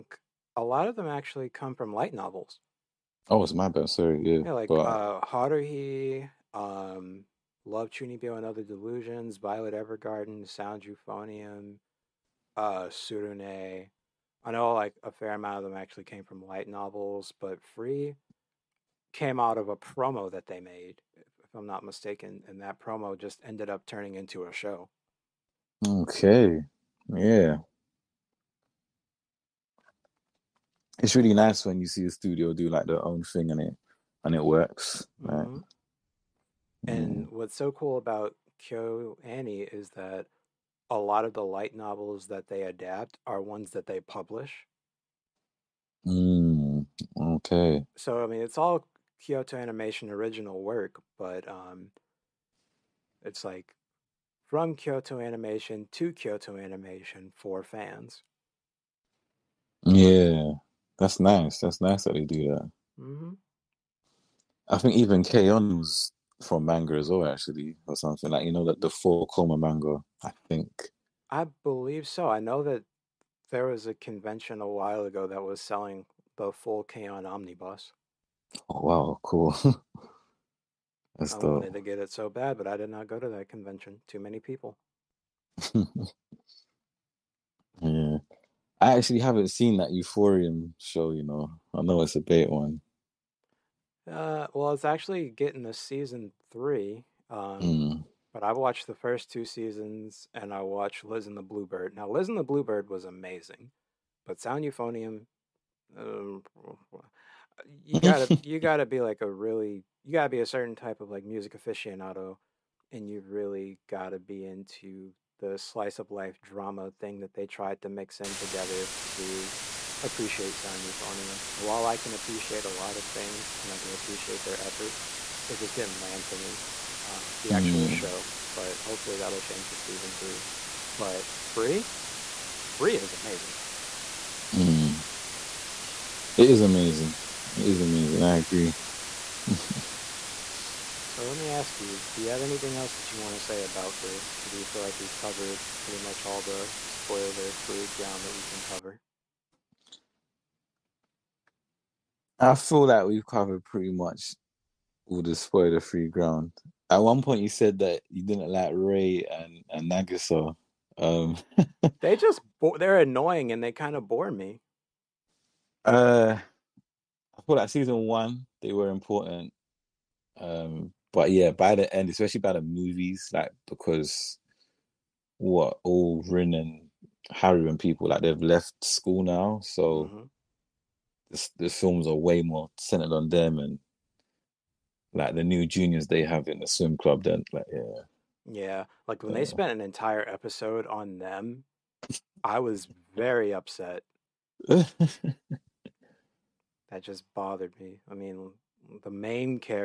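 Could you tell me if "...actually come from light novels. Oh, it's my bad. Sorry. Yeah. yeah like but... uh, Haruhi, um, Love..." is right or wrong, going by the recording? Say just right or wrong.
right.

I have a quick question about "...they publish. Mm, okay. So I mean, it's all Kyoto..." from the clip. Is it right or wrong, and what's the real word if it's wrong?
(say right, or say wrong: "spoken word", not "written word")
right.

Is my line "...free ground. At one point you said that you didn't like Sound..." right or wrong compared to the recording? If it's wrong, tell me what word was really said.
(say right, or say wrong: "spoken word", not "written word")
wrong: "Rei", not "Sound".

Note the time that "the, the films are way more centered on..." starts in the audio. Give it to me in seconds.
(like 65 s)
181 s.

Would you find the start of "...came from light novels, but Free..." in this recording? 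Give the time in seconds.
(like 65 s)
16 s.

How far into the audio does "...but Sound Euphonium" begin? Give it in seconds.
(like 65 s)
104 s.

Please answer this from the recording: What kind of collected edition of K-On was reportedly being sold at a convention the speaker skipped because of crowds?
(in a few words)
full K-On omnibus.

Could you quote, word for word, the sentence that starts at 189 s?
they spent an entire episode on them, I was very upset.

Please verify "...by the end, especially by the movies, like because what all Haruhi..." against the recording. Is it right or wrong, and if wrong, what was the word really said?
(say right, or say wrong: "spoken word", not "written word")
wrong: "Rin", not "Haruhi".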